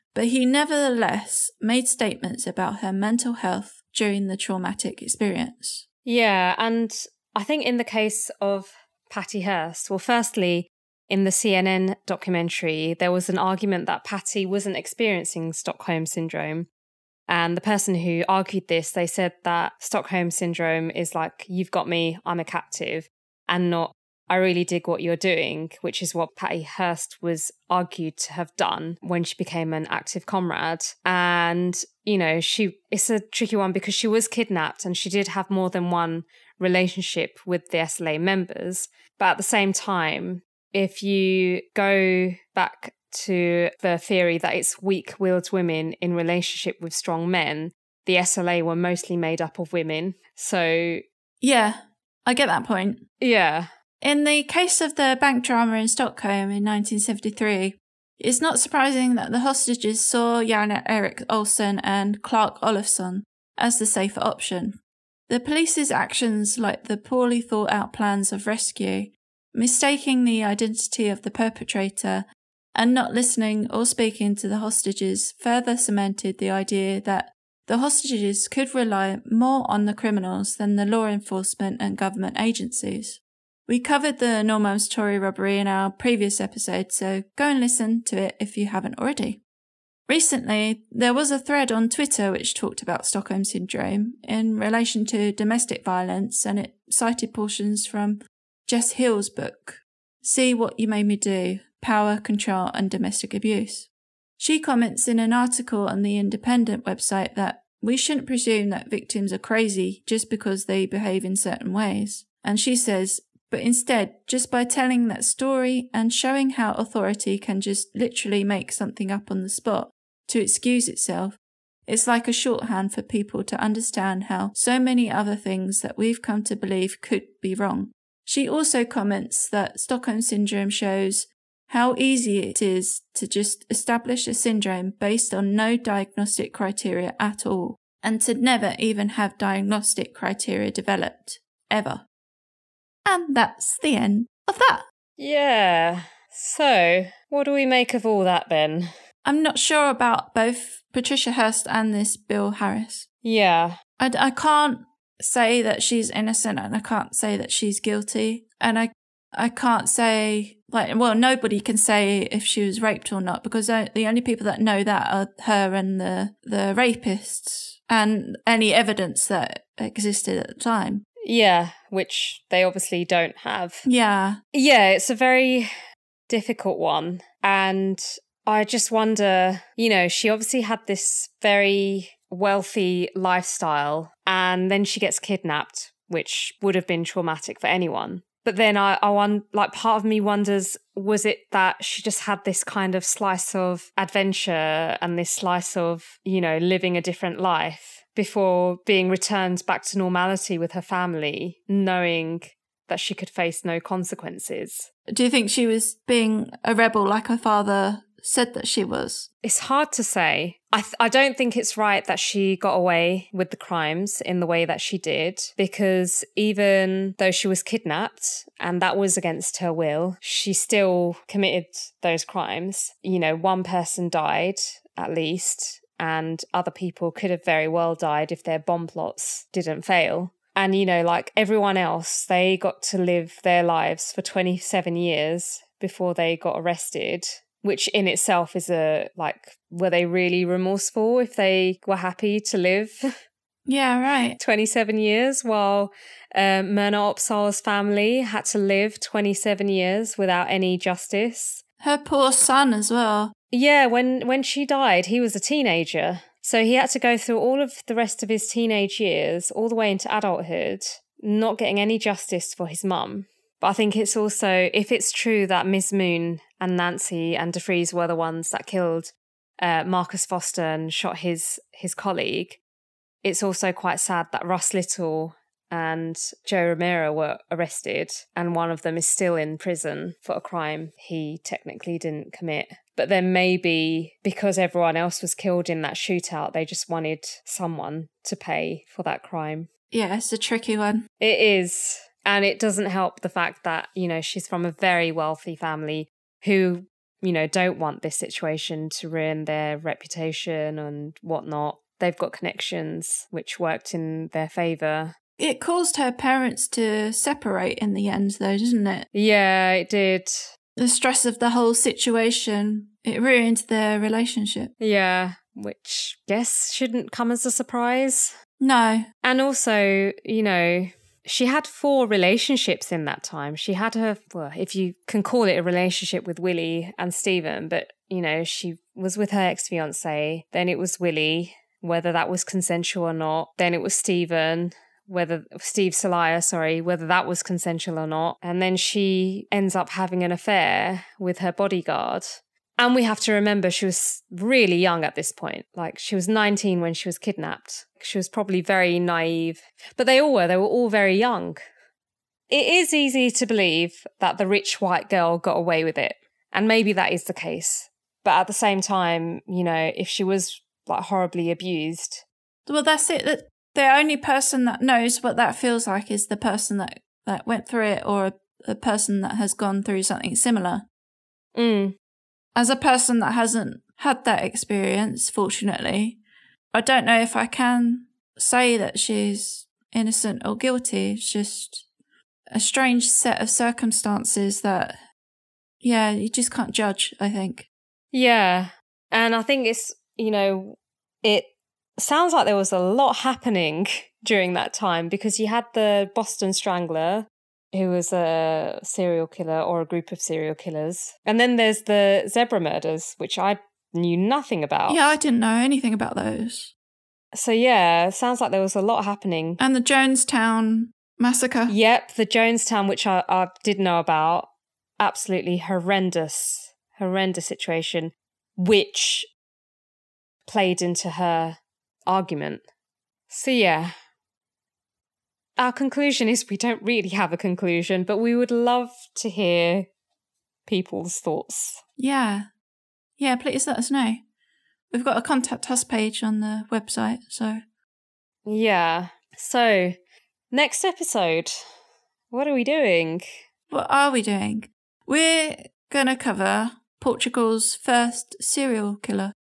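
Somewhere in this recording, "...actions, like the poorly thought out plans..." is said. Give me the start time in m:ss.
1:05.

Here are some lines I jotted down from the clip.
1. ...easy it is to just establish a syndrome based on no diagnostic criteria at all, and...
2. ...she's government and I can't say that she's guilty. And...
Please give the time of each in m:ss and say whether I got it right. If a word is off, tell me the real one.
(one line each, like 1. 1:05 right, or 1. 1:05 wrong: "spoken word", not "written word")
1. 2:11 right
2. 2:35 wrong: "innocent", not "government".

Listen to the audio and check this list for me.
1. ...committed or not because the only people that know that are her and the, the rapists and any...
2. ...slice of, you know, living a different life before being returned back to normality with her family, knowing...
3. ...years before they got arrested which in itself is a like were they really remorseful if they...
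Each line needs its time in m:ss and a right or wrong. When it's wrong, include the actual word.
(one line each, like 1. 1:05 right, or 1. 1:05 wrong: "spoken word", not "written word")
1. 2:42 wrong: "raped", not "committed"
2. 3:15 right
3. 3:54 right.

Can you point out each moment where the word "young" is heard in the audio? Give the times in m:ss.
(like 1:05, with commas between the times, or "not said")
5:44, 5:51.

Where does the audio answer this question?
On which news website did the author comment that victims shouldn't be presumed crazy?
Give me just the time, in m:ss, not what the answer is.
1:46.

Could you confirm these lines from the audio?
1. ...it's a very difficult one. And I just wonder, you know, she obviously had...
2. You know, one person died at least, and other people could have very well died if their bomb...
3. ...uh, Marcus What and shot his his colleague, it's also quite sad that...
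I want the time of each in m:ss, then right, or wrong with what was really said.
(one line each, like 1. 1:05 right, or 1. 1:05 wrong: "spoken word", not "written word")
1. 2:54 right
2. 3:43 right
3. 4:29 wrong: "Foster", not "What".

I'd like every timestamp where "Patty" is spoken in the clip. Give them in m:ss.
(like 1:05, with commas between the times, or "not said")
0:09, 0:14, 0:26.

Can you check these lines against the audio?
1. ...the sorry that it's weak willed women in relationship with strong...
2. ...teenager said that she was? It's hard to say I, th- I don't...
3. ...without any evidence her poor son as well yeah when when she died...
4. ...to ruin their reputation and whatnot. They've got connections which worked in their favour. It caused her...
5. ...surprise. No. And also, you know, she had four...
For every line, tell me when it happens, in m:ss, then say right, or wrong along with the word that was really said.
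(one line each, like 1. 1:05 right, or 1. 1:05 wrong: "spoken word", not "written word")
1. 0:43 wrong: "theory", not "sorry"
2. 3:27 wrong: "father", not "teenager"
3. 4:10 wrong: "justice", not "evidence"
4. 4:58 right
5. 5:17 right.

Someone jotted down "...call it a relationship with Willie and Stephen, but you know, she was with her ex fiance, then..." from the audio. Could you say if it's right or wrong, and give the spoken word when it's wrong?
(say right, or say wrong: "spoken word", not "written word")
right.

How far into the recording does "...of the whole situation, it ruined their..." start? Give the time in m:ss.
5:11.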